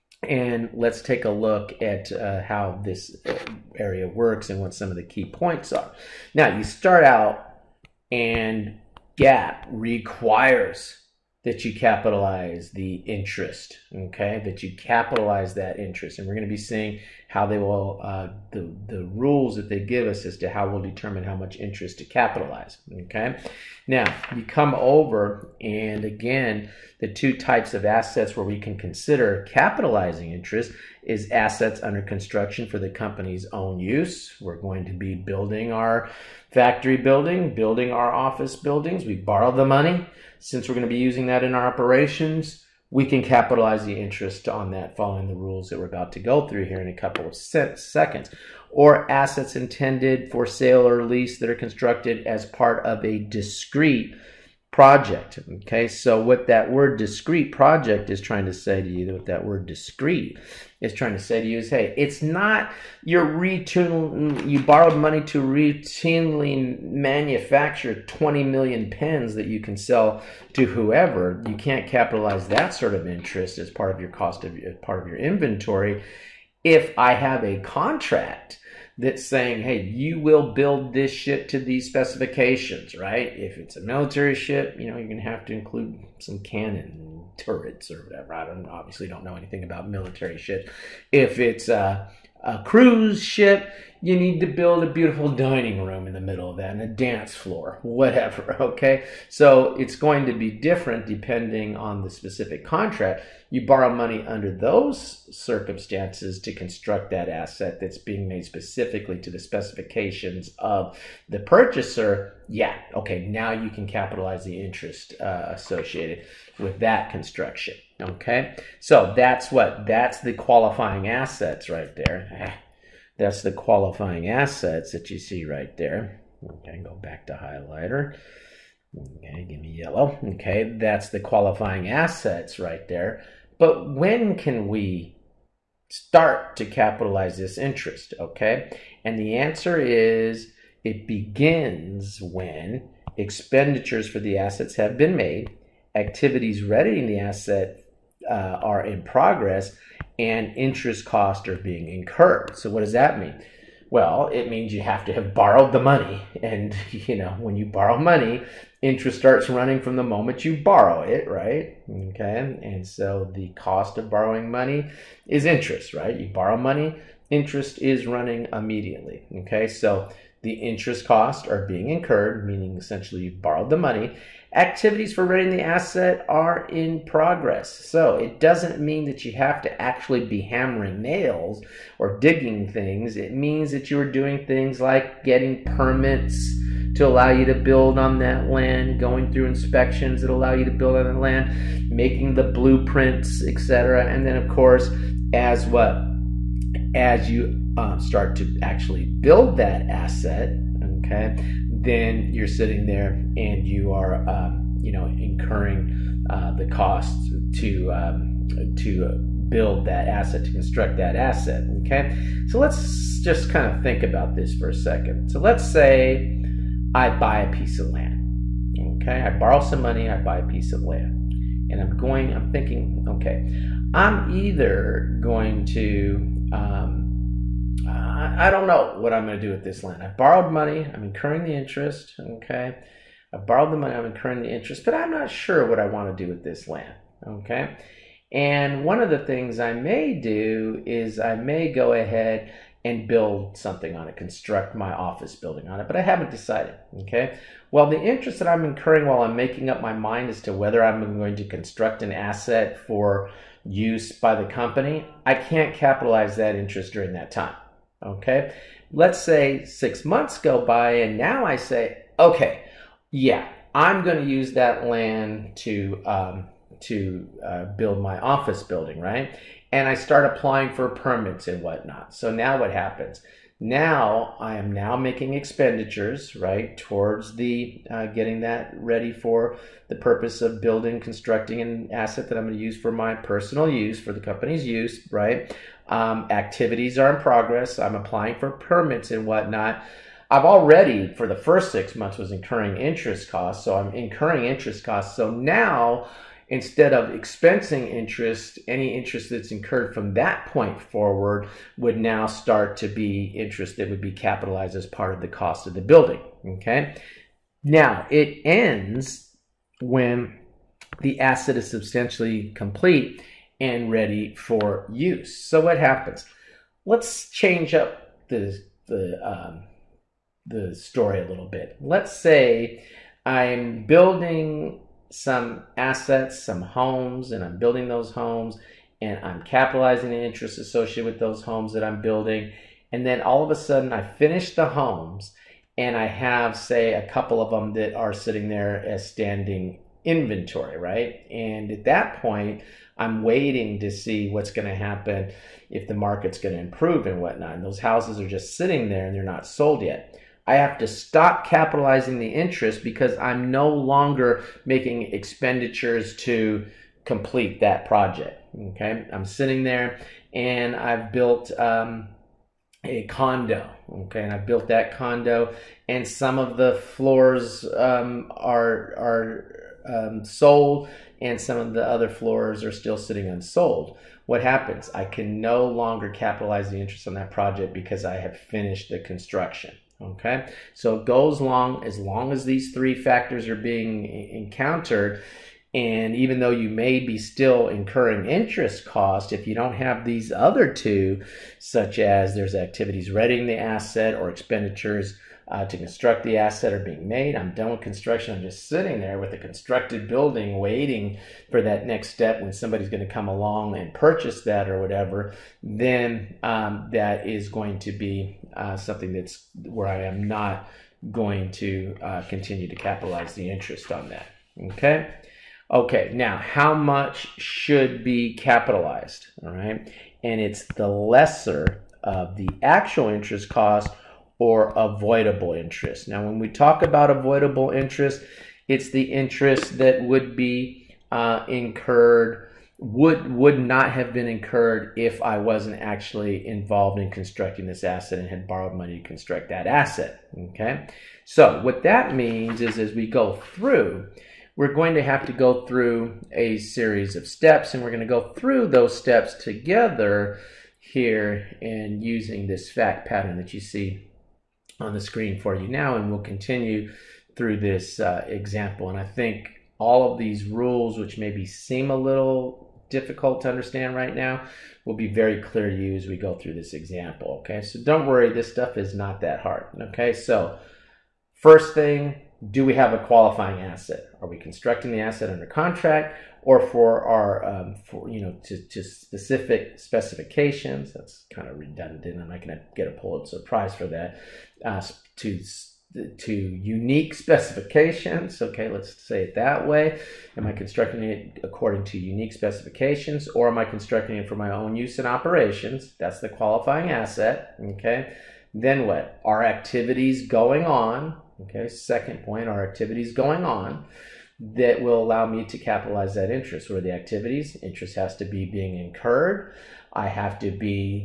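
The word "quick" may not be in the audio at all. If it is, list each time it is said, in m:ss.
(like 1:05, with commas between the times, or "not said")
not said.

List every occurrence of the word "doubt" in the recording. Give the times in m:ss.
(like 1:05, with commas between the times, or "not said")
not said.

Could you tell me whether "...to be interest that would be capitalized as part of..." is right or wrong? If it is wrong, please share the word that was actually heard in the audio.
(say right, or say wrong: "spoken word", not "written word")
right.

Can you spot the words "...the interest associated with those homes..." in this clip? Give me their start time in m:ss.
5:30.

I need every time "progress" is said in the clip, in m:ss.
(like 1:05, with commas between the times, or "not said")
2:29, 2:57, 4:47.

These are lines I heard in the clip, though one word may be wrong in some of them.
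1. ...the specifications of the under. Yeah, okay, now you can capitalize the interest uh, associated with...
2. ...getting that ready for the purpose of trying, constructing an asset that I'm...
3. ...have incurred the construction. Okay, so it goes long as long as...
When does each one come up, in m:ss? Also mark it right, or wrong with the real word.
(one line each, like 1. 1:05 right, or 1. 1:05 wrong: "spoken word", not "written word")
1. 1:49 wrong: "purchaser", not "under"
2. 4:38 wrong: "building", not "trying"
3. 6:18 wrong: "finished", not "incurred".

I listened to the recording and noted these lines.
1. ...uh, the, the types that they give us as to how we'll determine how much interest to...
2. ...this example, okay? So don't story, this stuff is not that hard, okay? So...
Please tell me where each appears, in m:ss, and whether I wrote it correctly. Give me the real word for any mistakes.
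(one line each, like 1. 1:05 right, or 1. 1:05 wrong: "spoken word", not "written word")
1. 0:18 wrong: "rules", not "types"
2. 7:46 wrong: "worry", not "story".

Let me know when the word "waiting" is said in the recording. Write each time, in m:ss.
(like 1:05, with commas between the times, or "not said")
5:43, 6:40.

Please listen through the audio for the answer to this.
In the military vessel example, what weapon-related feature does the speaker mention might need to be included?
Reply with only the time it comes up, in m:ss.
1:26.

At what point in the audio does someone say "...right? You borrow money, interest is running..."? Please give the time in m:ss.
2:45.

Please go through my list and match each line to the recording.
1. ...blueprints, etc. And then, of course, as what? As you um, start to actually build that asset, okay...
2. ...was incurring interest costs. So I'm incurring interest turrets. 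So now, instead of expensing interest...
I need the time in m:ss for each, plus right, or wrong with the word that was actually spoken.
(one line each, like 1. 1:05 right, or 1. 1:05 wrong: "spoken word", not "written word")
1. 3:12 right
2. 4:52 wrong: "costs", not "turrets".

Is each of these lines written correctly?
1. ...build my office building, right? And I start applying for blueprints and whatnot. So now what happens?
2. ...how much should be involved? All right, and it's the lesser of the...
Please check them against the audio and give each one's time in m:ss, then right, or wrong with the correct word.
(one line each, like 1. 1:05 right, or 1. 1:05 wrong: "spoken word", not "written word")
1. 4:27 wrong: "permits", not "blueprints"
2. 6:56 wrong: "capitalized", not "involved".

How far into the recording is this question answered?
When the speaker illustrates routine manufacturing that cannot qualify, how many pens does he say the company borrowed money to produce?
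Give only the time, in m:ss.
1:08.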